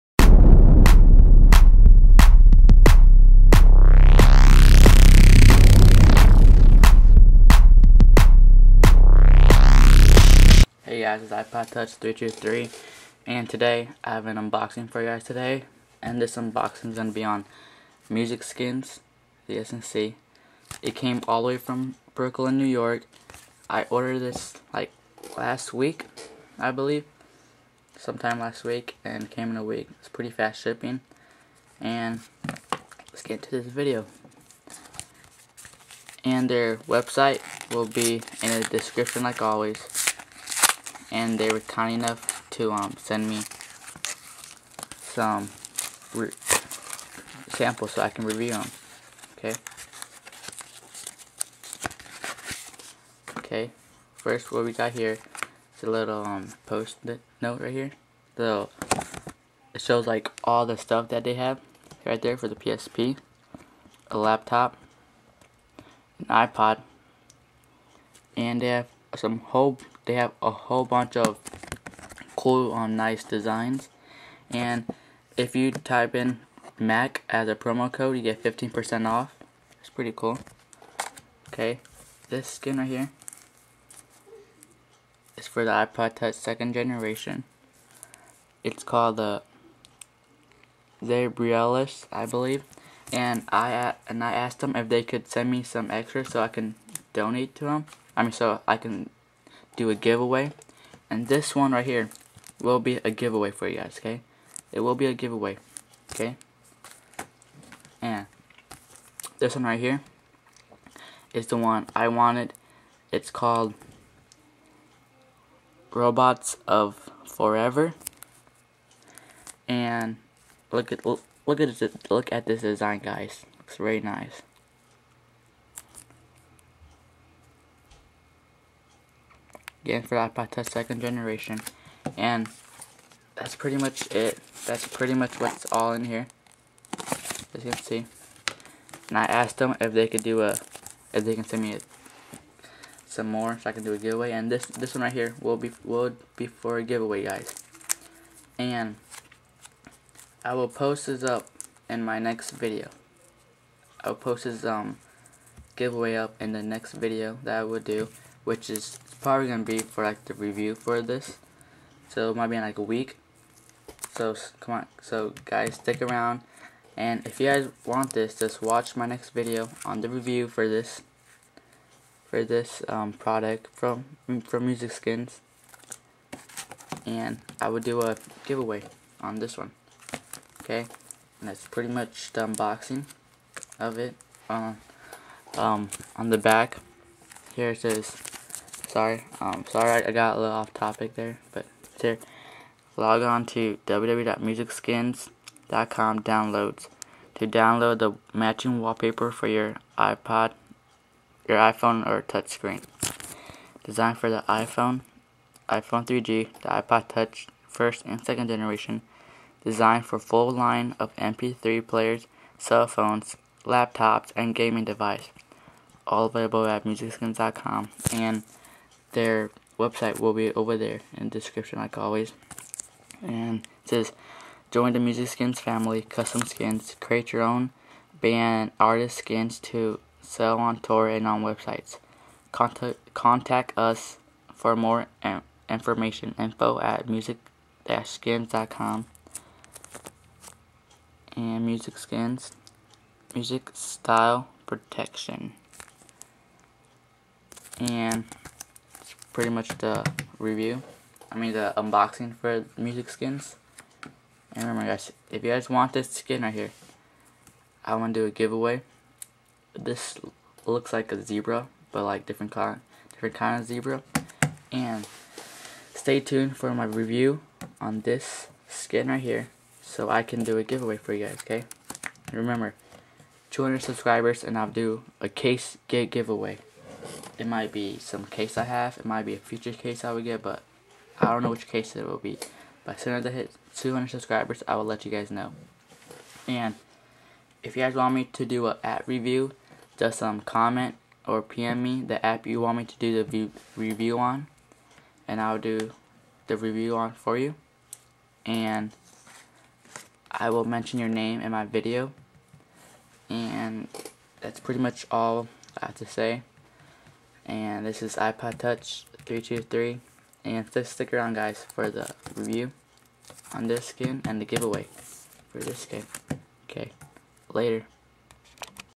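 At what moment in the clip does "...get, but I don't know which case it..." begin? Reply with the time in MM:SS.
04:40.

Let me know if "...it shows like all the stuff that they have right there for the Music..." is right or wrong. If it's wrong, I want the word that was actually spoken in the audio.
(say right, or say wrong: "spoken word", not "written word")
wrong: "PSP", not "Music".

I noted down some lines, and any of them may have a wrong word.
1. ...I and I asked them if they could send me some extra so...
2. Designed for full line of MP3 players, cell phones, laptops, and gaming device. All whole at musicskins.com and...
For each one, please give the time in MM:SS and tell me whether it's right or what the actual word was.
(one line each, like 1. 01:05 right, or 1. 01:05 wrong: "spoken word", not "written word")
1. 01:33 right
2. 03:29 wrong: "available", not "whole".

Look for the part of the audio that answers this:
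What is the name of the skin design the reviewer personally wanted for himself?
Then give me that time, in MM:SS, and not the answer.
01:55.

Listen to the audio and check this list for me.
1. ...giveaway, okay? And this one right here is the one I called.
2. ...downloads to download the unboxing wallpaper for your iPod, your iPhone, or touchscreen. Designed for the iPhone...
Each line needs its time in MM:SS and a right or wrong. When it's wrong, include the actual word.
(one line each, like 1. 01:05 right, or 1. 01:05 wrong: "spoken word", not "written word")
1. 01:45 wrong: "wanted", not "called"
2. 03:16 wrong: "matching", not "unboxing".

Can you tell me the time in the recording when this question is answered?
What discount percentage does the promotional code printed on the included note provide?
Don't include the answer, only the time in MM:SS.
01:18.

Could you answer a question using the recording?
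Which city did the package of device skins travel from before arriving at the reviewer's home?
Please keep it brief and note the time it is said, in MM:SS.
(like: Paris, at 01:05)
Brooklyn, New York, at 00:22.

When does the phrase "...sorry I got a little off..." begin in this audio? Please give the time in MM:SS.
03:09.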